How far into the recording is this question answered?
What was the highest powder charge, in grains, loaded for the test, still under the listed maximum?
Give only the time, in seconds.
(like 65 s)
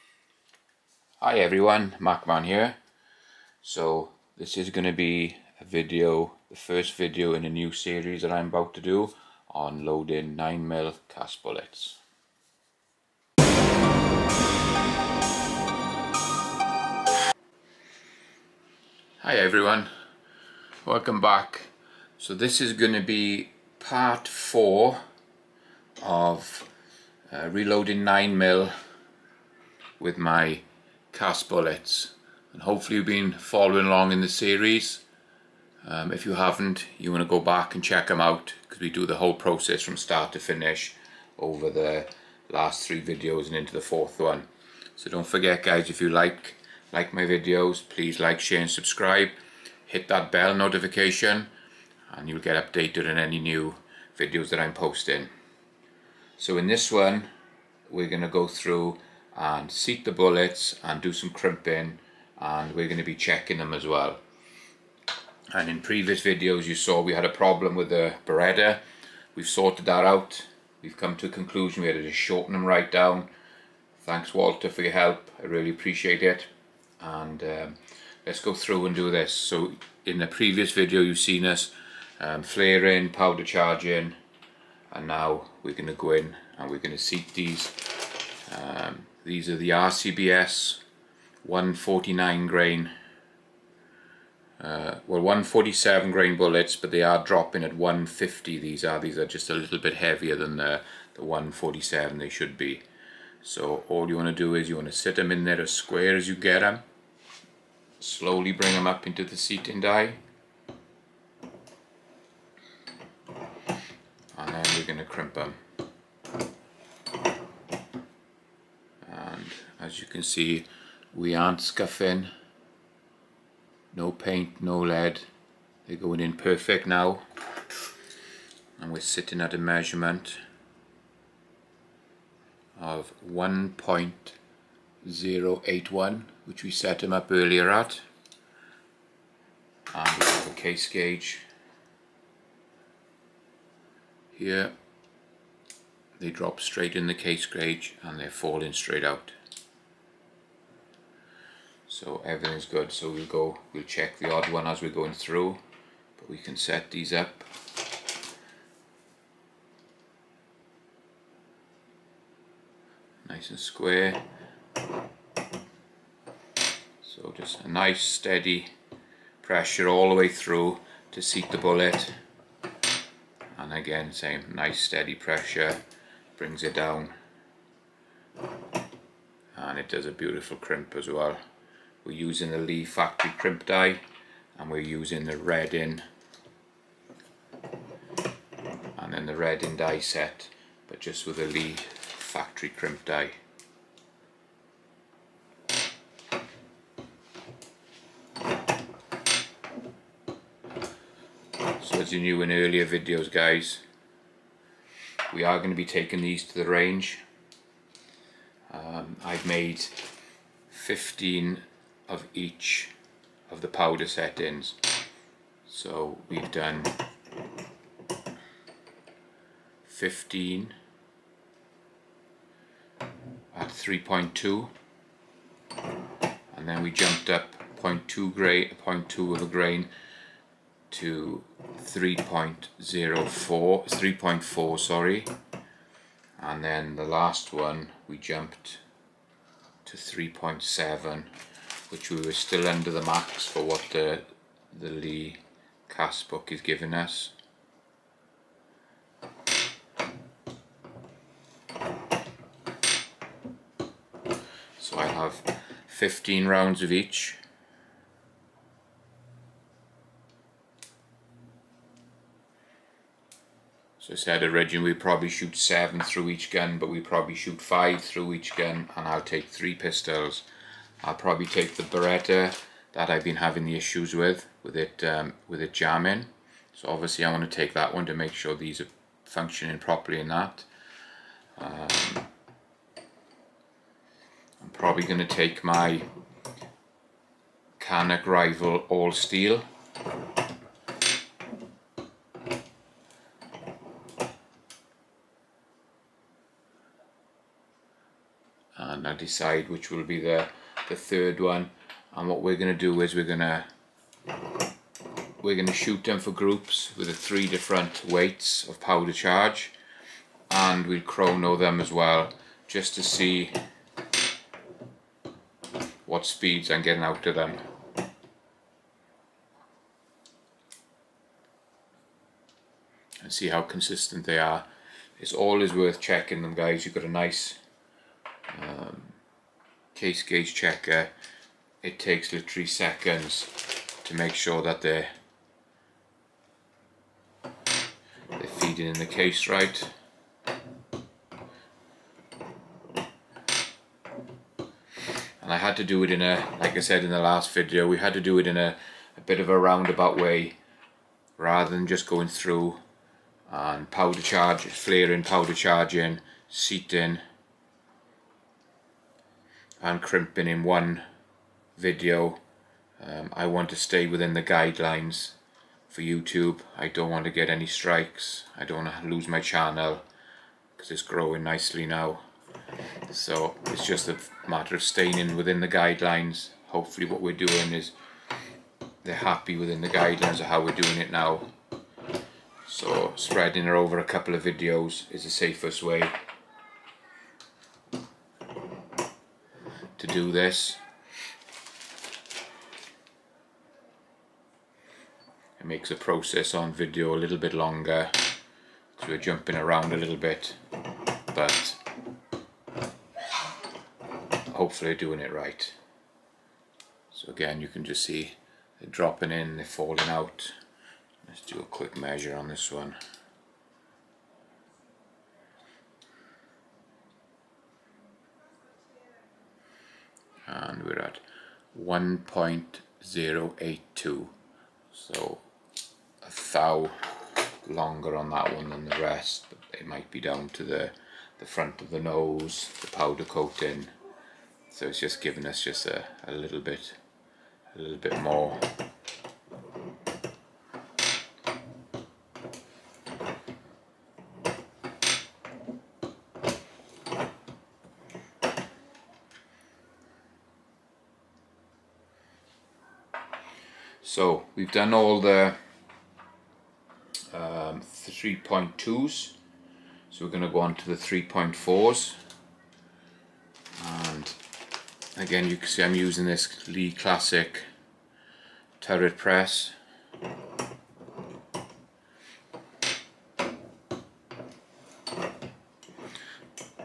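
239 s.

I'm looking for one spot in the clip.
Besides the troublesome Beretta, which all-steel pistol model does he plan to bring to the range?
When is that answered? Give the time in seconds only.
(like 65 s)
287 s.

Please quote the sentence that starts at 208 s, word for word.
Um, I've made 15 of each of the powder settings.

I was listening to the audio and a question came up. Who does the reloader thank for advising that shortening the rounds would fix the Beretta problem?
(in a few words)
Walter.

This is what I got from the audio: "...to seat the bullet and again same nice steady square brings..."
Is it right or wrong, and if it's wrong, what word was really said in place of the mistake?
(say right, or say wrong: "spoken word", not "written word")
wrong: "pressure", not "square".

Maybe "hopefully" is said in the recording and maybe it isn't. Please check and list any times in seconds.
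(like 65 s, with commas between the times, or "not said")
32 s, 376 s, 404 s.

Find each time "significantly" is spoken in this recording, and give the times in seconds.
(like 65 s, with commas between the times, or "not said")
not said.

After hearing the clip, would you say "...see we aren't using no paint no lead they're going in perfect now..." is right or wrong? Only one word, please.
wrong.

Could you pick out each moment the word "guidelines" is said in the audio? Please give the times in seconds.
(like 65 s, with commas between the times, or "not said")
364 s, 375 s, 379 s.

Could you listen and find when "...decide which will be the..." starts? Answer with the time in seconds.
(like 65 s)
299 s.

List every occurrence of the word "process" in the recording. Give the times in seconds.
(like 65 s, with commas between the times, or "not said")
39 s, 395 s.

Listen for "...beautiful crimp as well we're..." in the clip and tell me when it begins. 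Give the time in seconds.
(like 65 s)
180 s.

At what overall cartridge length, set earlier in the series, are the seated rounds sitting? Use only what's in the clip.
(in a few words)
1.081.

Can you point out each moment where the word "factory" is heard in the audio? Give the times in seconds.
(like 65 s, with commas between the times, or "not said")
182 s, 191 s.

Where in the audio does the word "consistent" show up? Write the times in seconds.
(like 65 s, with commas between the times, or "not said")
323 s.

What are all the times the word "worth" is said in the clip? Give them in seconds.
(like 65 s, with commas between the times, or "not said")
325 s.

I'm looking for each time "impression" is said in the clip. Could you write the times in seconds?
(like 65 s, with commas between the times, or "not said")
not said.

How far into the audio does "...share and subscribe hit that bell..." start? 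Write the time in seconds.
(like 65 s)
48 s.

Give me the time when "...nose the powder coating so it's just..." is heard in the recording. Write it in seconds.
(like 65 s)
431 s.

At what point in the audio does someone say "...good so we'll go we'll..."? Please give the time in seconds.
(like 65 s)
152 s.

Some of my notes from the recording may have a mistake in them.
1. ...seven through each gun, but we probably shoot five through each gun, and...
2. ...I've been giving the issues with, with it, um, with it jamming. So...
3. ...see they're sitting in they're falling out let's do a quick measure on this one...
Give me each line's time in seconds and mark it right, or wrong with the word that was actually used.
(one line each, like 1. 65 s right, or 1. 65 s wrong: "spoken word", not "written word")
1. 265 s right
2. 273 s wrong: "having", not "giving"
3. 408 s wrong: "dropping", not "sitting".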